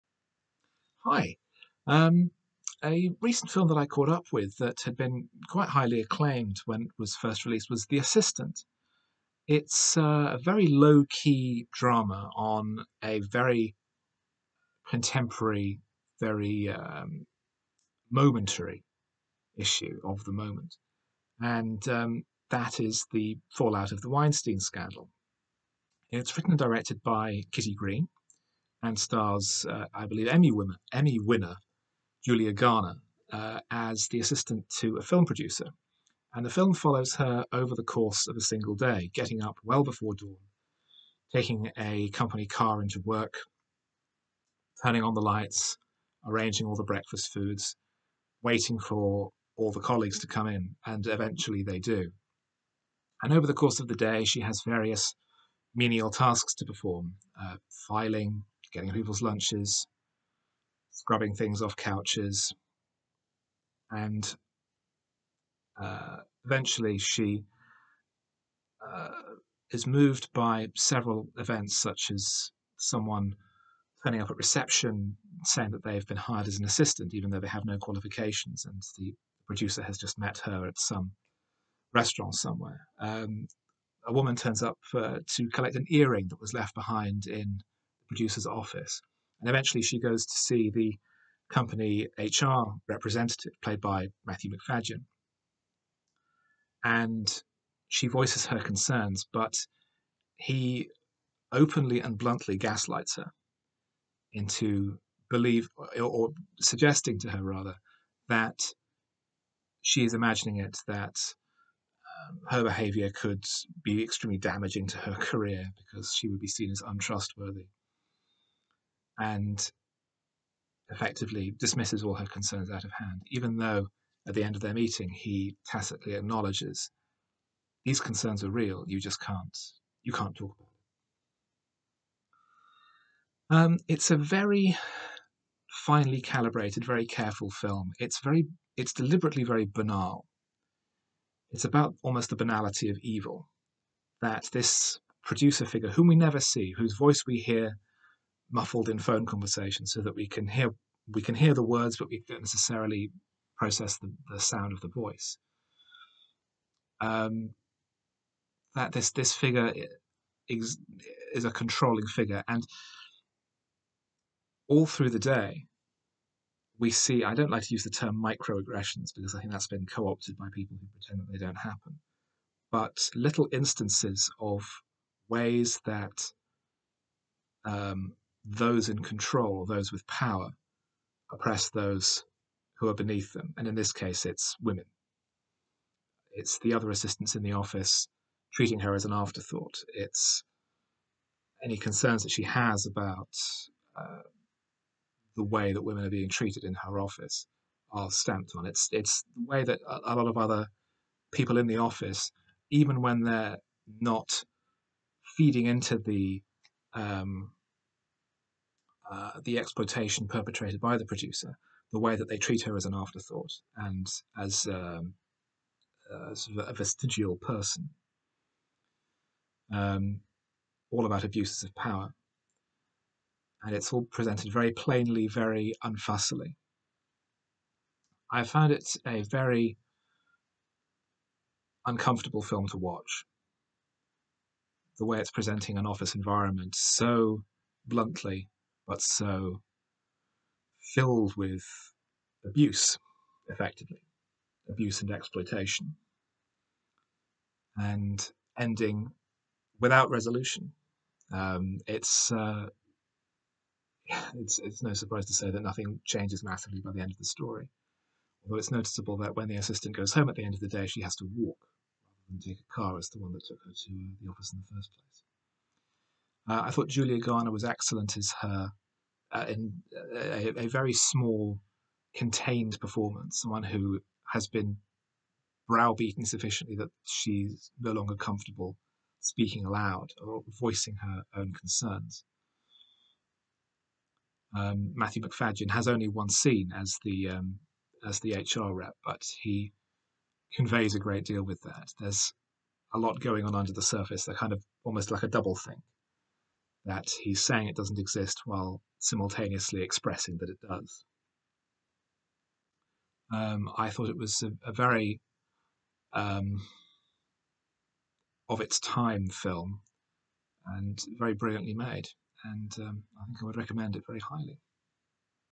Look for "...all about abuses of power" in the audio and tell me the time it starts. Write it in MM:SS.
03:40.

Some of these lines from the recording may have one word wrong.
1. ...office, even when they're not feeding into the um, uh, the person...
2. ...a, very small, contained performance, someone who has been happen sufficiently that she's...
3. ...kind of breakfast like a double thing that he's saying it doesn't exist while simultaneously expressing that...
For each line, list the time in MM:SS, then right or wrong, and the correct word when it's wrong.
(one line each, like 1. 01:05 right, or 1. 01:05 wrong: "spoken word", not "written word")
1. 03:21 wrong: "exploitation", not "person"
2. 04:30 wrong: "browbeaten", not "happen"
3. 04:54 wrong: "almost", not "breakfast".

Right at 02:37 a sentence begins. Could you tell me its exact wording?
Um, that this this figure is, is a controlling figure, and all through the day, we see.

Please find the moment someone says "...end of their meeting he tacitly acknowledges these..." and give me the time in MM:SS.
02:04.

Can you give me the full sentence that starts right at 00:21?
And um, that is the fallout of the Weinstein scandal.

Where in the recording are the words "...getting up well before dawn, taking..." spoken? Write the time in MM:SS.
00:39.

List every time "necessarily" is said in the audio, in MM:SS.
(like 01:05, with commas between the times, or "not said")
02:32.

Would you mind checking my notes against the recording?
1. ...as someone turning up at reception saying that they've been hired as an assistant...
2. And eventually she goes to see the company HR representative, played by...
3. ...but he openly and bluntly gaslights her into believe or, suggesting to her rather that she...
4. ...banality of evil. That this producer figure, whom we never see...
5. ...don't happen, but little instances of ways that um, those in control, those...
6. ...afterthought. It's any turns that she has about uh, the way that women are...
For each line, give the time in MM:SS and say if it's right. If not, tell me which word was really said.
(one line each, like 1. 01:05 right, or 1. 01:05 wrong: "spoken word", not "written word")
1. 01:12 right
2. 01:29 right
3. 01:39 right
4. 02:22 right
5. 02:51 right
6. 03:09 wrong: "concerns", not "turns".